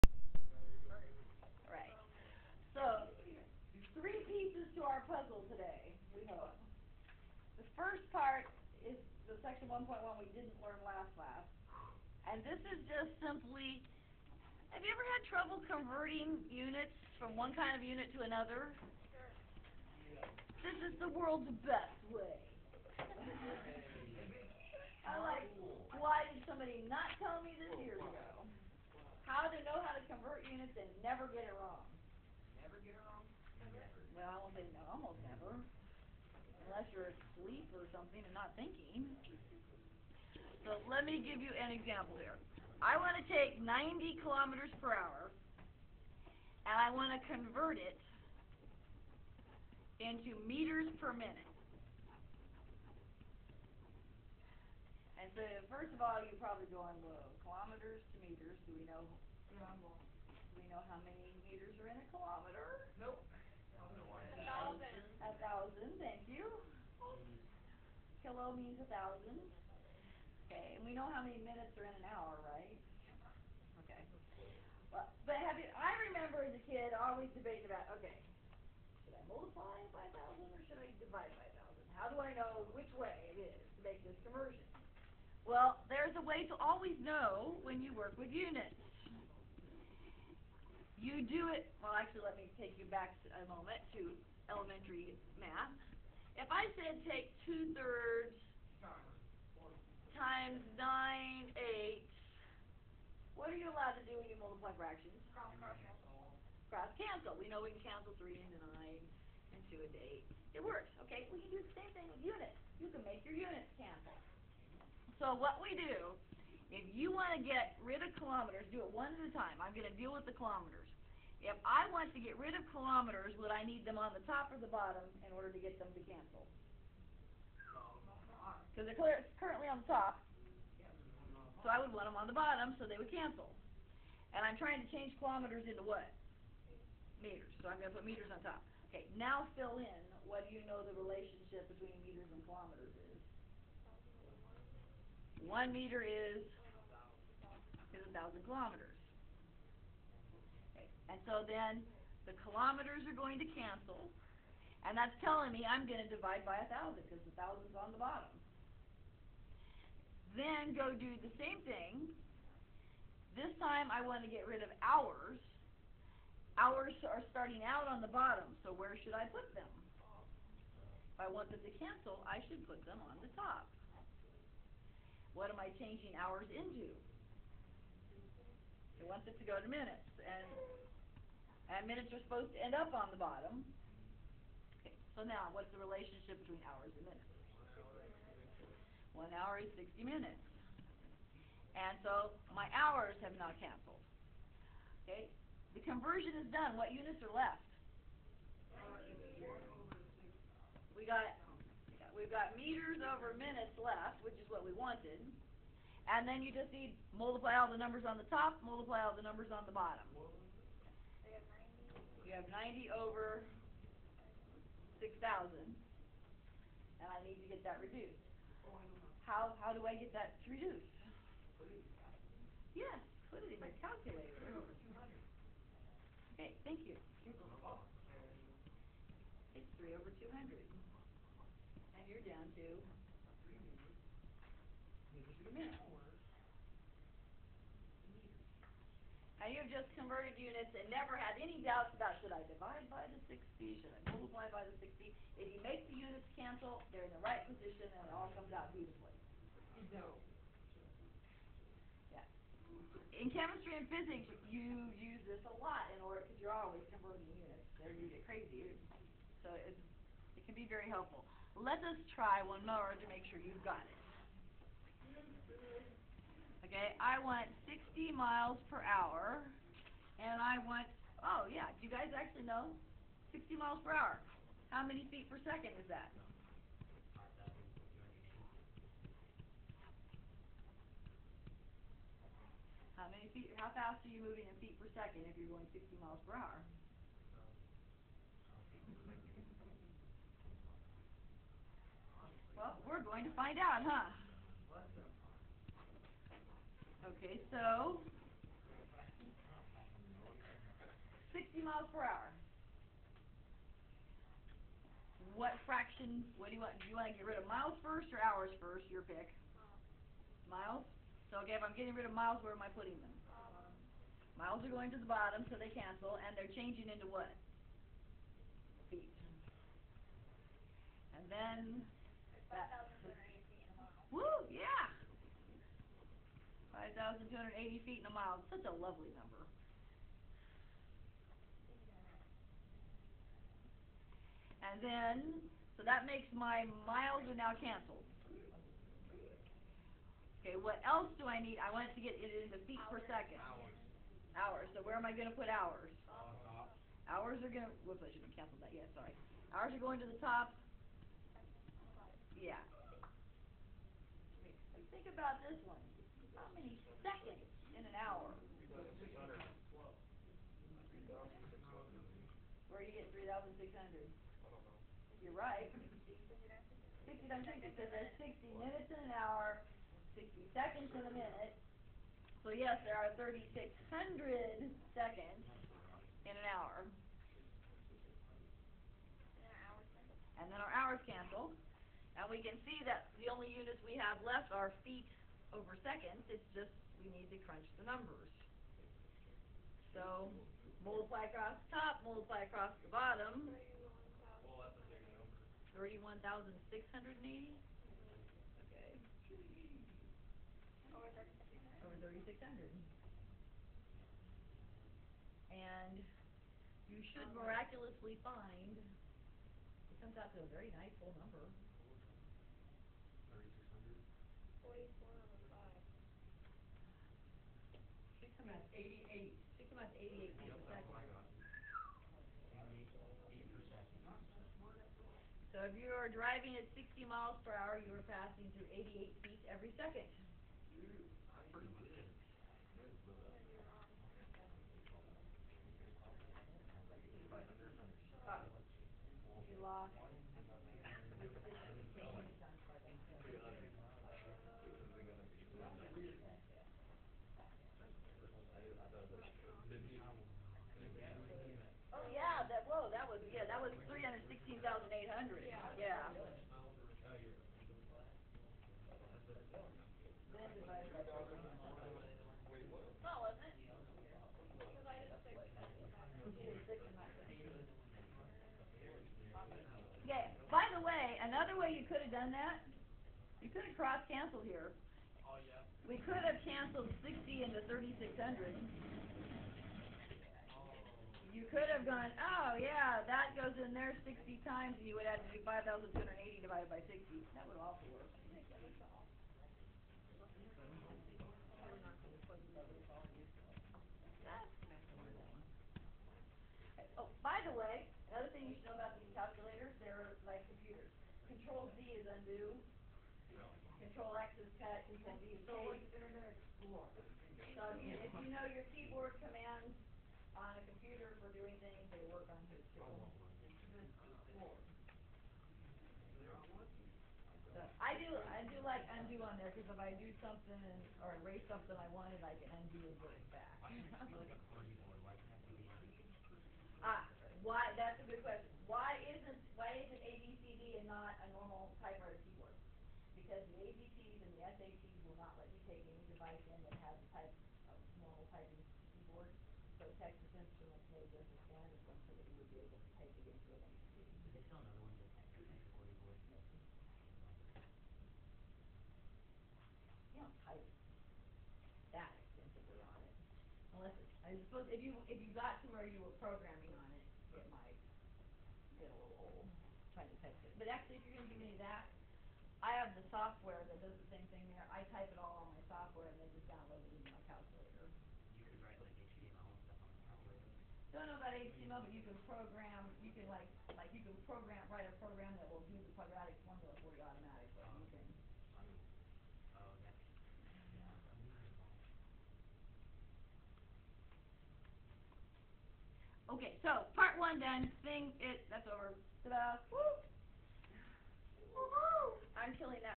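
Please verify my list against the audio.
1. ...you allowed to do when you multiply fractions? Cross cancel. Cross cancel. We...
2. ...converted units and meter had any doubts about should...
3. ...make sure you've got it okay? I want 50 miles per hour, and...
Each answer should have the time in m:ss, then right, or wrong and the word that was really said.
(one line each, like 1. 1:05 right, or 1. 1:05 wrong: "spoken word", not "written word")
1. 1:43 right
2. 3:59 wrong: "never", not "meter"
3. 4:23 wrong: "60", not "50".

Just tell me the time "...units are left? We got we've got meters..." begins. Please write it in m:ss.
3:16.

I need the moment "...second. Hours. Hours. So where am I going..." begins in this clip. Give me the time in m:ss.
5:43.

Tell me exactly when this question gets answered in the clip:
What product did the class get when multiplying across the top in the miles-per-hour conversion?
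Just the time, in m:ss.
6:35.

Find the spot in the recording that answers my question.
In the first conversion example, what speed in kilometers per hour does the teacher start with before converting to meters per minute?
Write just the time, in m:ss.
0:43.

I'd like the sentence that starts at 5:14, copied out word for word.
Miles are going to the bottom, so they cancel, and they're changing into what?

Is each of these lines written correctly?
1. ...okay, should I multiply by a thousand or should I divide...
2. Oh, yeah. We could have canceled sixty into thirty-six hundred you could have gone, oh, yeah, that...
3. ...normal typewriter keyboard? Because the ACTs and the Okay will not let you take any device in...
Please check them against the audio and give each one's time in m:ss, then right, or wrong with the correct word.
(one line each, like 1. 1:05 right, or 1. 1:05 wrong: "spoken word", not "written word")
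1. 1:17 right
2. 7:55 right
3. 8:51 wrong: "SATs", not "Okay".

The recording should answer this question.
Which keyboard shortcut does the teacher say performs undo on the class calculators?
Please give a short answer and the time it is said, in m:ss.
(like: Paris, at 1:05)
Control Z, at 8:21.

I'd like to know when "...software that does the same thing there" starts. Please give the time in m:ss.
9:23.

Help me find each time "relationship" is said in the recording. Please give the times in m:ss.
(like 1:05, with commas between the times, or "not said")
2:20, 3:05.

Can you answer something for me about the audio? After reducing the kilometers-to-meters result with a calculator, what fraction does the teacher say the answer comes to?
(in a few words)
3/200.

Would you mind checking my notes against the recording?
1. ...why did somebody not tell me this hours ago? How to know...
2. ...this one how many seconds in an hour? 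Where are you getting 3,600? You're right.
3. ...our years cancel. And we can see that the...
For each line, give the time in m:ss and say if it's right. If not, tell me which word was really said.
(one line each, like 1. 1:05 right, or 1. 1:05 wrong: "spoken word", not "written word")
1. 0:25 wrong: "years", not "hours"
2. 5:55 right
3. 6:20 wrong: "hours", not "years".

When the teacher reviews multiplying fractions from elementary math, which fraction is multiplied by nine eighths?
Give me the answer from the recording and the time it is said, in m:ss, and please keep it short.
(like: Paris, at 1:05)
two-thirds, at 1:37.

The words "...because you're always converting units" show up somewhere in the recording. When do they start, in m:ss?
4:16.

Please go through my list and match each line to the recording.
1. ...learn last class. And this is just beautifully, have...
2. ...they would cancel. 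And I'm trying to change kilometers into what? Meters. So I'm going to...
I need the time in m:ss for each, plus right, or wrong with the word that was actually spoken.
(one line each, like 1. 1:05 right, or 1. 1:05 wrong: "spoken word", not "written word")
1. 0:10 wrong: "simply", not "beautifully"
2. 2:12 right.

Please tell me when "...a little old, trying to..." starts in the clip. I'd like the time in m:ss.
9:18.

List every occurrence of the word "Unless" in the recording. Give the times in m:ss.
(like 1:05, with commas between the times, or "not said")
0:36, 9:13.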